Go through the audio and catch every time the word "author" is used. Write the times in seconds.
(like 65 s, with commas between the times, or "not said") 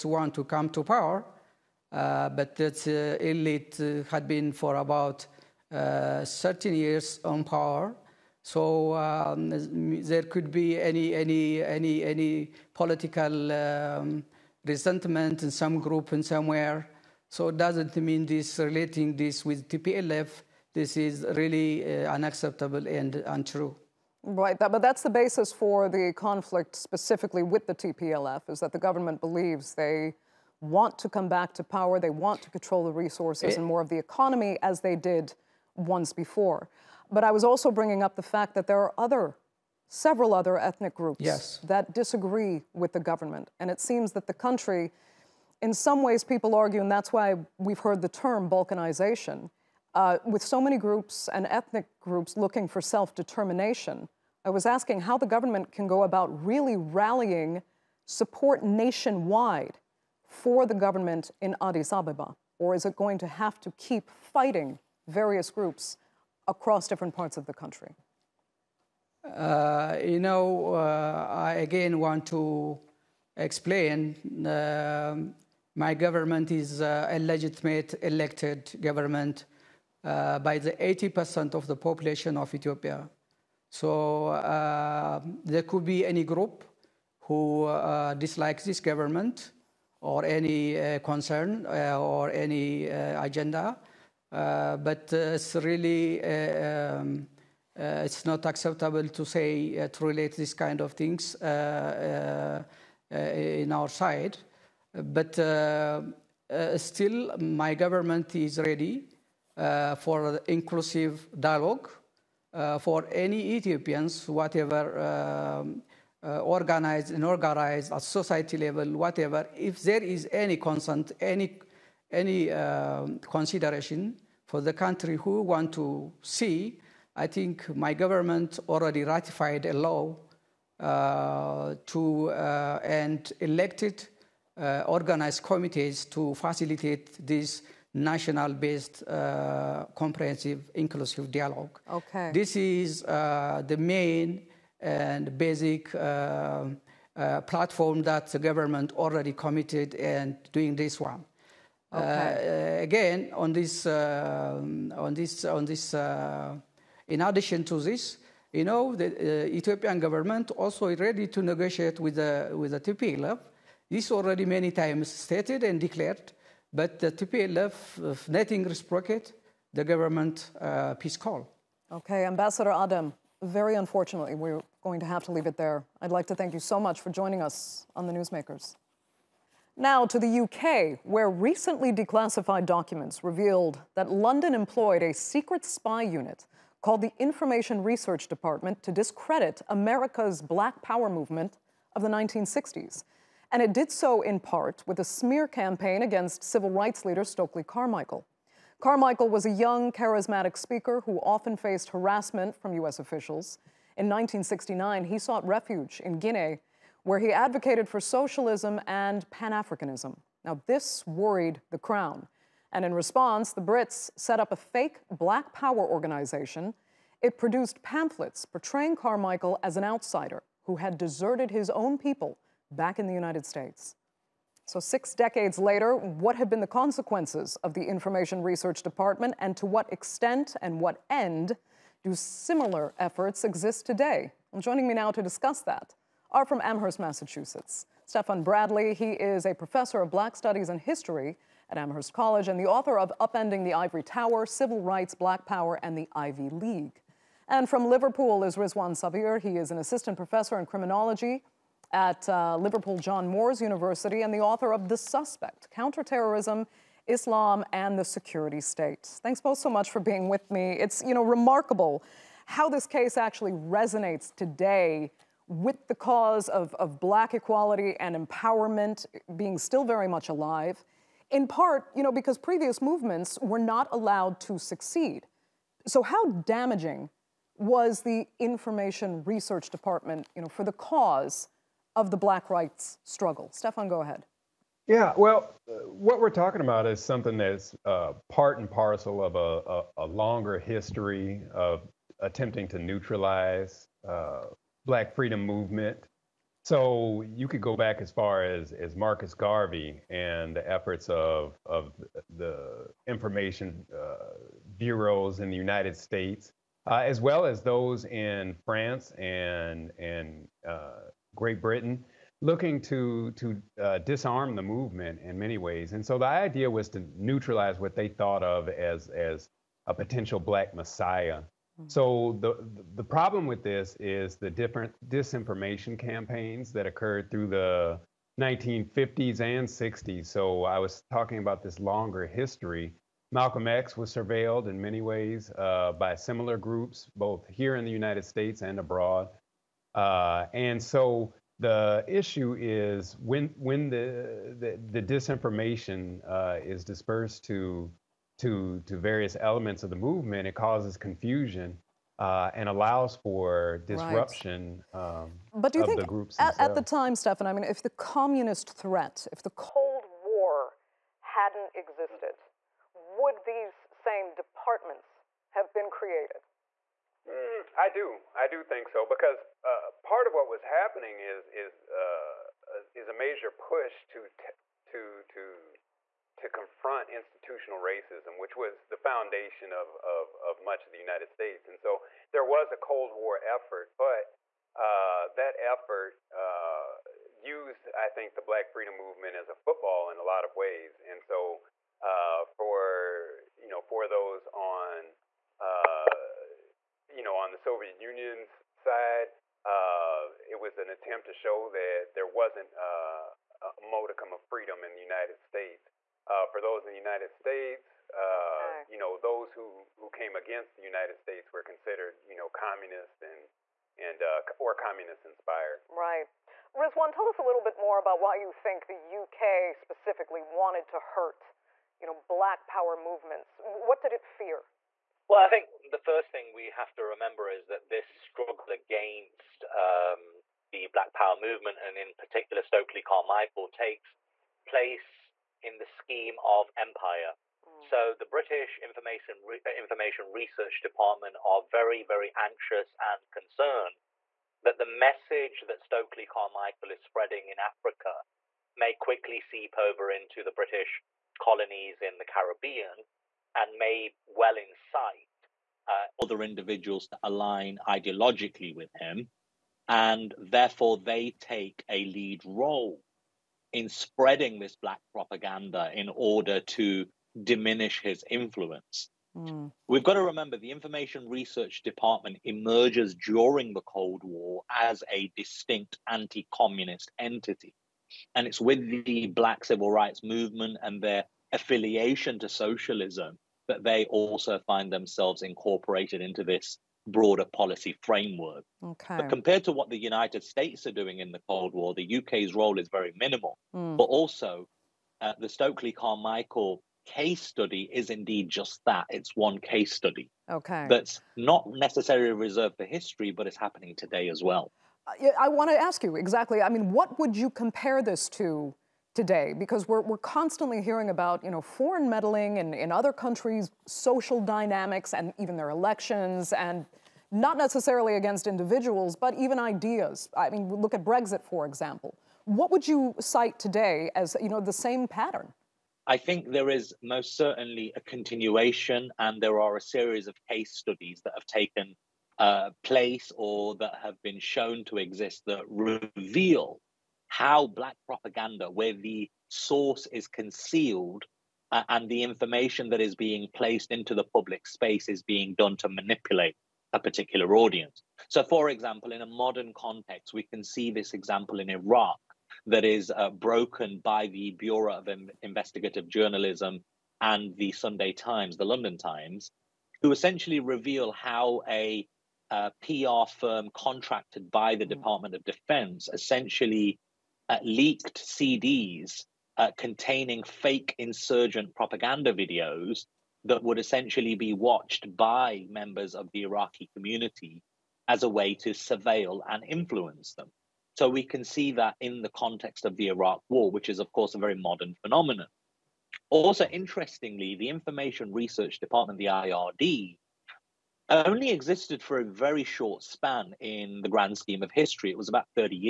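242 s, 254 s.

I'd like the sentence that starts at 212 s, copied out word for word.
And in response, the Brits set up a fake black power organization.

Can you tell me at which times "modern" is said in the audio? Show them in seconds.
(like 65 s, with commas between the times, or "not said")
549 s, 584 s.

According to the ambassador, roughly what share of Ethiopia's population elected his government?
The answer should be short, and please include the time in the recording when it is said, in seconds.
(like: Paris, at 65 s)
80%, at 80 s.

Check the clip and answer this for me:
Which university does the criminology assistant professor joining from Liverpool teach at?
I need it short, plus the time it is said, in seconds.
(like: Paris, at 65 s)
Liverpool John Moores University, at 252 s.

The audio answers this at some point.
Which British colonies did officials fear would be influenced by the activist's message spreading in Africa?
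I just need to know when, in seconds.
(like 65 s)
452 s.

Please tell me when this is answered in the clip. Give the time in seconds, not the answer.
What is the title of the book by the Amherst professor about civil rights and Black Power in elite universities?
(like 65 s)
243 s.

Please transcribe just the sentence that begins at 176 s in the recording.
I'd like to thank you so much for joining us on the Newsmakers.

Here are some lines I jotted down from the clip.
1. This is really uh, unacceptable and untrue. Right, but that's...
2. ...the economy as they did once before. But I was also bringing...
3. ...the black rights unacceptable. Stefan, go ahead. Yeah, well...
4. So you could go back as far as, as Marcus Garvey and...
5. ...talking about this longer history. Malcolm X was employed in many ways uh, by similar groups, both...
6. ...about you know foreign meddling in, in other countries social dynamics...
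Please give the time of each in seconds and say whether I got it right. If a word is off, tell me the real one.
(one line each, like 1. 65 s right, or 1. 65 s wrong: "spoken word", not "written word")
1. 20 s right
2. 33 s right
3. 282 s wrong: "struggle", not "unacceptable"
4. 296 s right
5. 331 s wrong: "surveilled", not "employed"
6. 511 s right.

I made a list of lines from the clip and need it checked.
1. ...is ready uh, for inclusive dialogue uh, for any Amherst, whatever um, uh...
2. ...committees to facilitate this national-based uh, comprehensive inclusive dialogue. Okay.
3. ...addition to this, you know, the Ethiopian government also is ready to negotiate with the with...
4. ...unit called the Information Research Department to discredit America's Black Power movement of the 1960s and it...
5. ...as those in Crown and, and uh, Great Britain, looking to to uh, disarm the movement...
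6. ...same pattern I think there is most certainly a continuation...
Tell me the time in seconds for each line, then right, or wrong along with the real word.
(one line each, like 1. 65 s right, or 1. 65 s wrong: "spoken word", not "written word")
1. 108 s wrong: "Ethiopians", not "Amherst"
2. 135 s right
3. 157 s right
4. 186 s right
5. 307 s wrong: "France", not "Crown"
6. 524 s right.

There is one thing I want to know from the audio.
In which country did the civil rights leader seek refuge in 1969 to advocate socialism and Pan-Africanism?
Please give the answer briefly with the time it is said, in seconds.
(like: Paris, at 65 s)
Guinea, at 206 s.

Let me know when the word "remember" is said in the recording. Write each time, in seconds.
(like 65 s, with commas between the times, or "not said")
427 s, 470 s.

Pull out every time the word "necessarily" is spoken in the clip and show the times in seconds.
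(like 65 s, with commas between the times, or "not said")
501 s, 517 s.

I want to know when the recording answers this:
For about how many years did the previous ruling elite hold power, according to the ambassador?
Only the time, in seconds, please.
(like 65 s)
6 s.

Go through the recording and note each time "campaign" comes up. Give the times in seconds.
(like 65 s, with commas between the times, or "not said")
195 s, 325 s.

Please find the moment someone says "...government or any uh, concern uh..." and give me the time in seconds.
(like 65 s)
88 s.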